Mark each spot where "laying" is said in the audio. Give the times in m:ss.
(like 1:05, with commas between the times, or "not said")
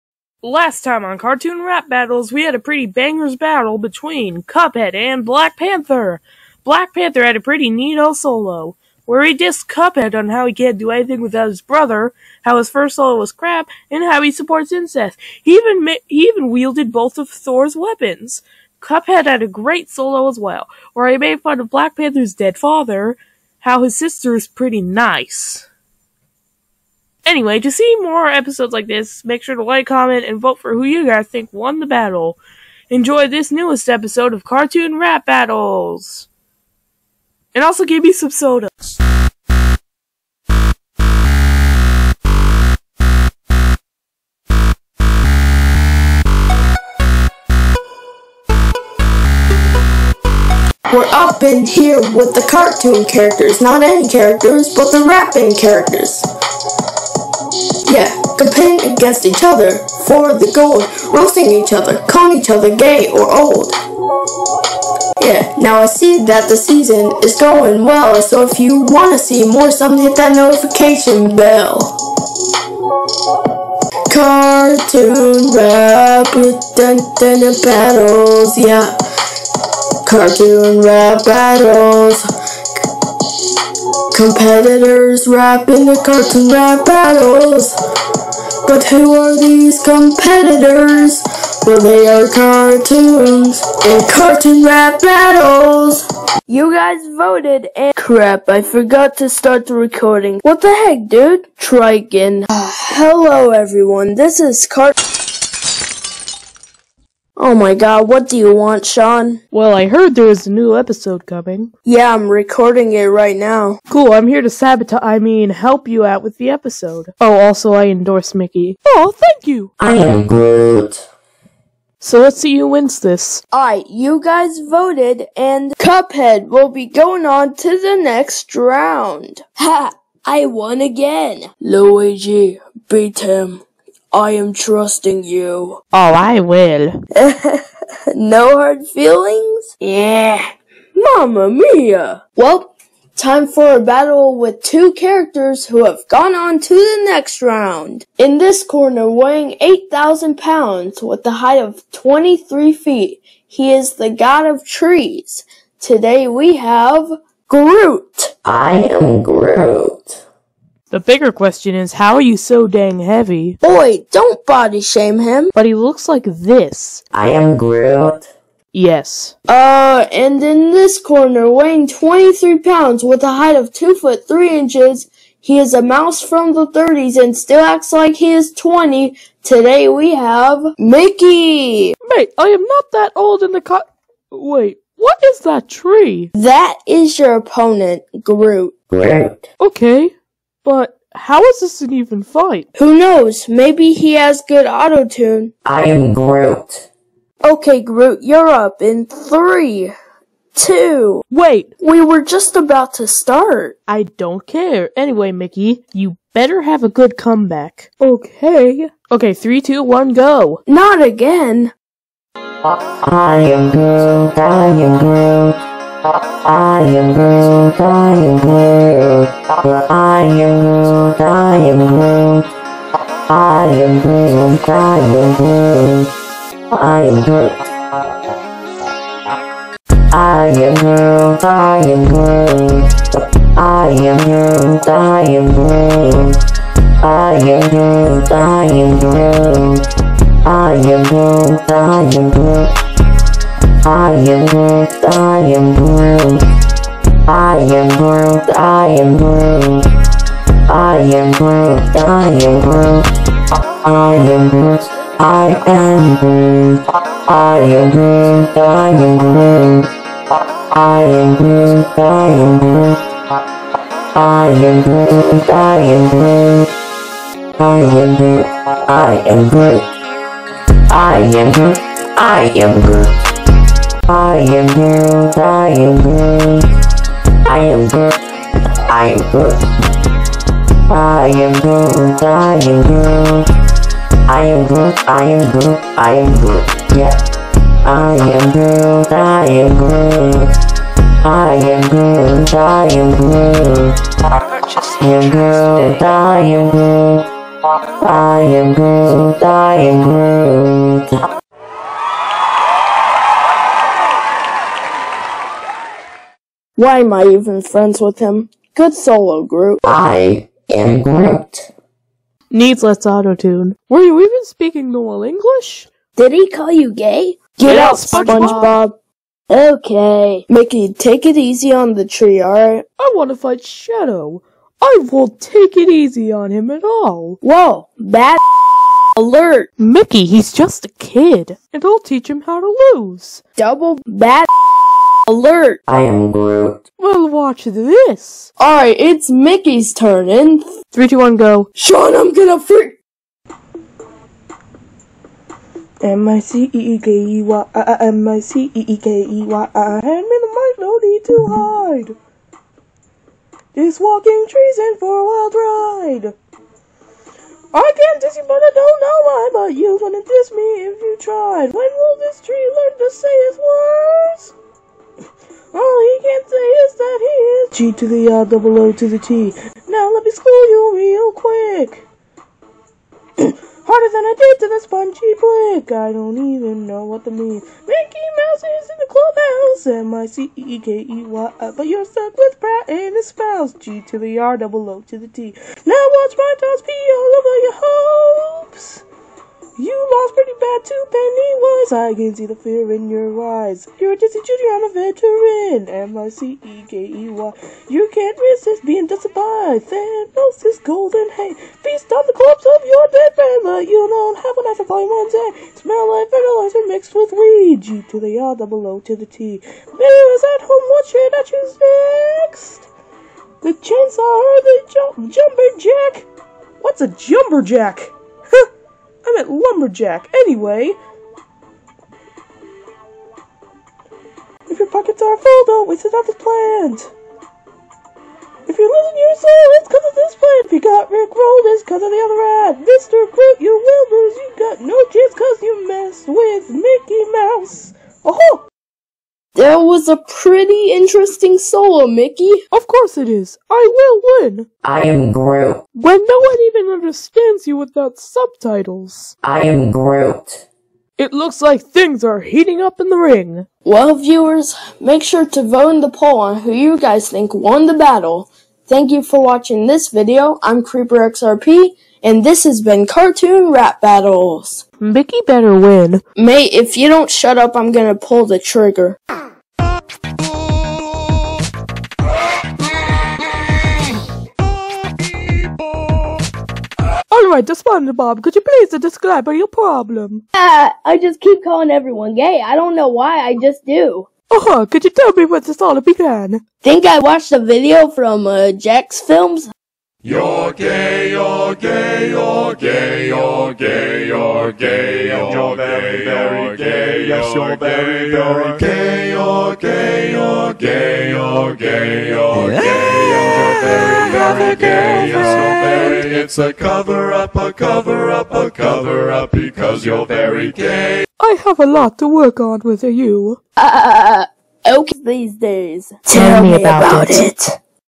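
not said.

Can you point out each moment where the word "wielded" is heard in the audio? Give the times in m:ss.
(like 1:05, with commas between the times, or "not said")
0:16.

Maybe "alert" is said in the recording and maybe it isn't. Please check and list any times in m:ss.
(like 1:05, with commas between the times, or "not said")
5:29, 5:35.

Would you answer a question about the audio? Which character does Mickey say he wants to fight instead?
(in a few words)
Shadow.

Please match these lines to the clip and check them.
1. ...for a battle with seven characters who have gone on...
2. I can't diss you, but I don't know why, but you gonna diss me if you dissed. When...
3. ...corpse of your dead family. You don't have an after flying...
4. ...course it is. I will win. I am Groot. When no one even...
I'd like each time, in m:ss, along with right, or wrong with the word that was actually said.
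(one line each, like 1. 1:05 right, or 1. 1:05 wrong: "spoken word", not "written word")
1. 2:23 wrong: "two", not "seven"
2. 5:57 wrong: "tried", not "dissed"
3. 6:42 right
4. 7:22 right.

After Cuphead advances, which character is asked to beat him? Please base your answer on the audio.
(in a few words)
Luigi.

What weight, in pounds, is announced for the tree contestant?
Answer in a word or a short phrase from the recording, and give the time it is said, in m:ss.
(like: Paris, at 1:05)
8,000, at 2:29.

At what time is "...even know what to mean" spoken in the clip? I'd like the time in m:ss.
6:16.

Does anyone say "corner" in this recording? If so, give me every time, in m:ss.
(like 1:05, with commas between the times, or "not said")
2:28, 2:50.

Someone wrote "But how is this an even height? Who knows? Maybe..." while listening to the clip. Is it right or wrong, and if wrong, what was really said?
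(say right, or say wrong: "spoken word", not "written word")
wrong: "fight", not "height".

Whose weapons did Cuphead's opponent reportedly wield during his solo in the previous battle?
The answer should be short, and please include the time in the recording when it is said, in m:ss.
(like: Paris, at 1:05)
Thor, at 0:17.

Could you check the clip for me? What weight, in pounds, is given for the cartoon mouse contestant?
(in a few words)
23.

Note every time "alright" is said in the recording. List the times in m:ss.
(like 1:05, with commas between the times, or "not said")
2:03, 5:22, 5:38, 7:57.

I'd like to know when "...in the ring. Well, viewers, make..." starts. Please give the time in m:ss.
7:33.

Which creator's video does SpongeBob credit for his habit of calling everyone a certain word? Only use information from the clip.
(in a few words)
JacksFilms.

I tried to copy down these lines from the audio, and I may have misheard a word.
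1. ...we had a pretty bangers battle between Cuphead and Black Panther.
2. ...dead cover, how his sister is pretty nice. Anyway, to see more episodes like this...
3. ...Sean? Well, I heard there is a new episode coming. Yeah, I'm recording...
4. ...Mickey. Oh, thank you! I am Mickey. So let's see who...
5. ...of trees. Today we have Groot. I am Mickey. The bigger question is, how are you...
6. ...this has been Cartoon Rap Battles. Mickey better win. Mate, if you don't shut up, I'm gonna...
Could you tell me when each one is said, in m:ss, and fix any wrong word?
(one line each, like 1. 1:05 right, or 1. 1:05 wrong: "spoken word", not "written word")
1. 0:02 right
2. 0:22 wrong: "father", not "cover"
3. 1:48 right
4. 1:58 wrong: "Groot", not "Mickey"
5. 2:34 wrong: "Groot", not "Mickey"
6. 7:42 right.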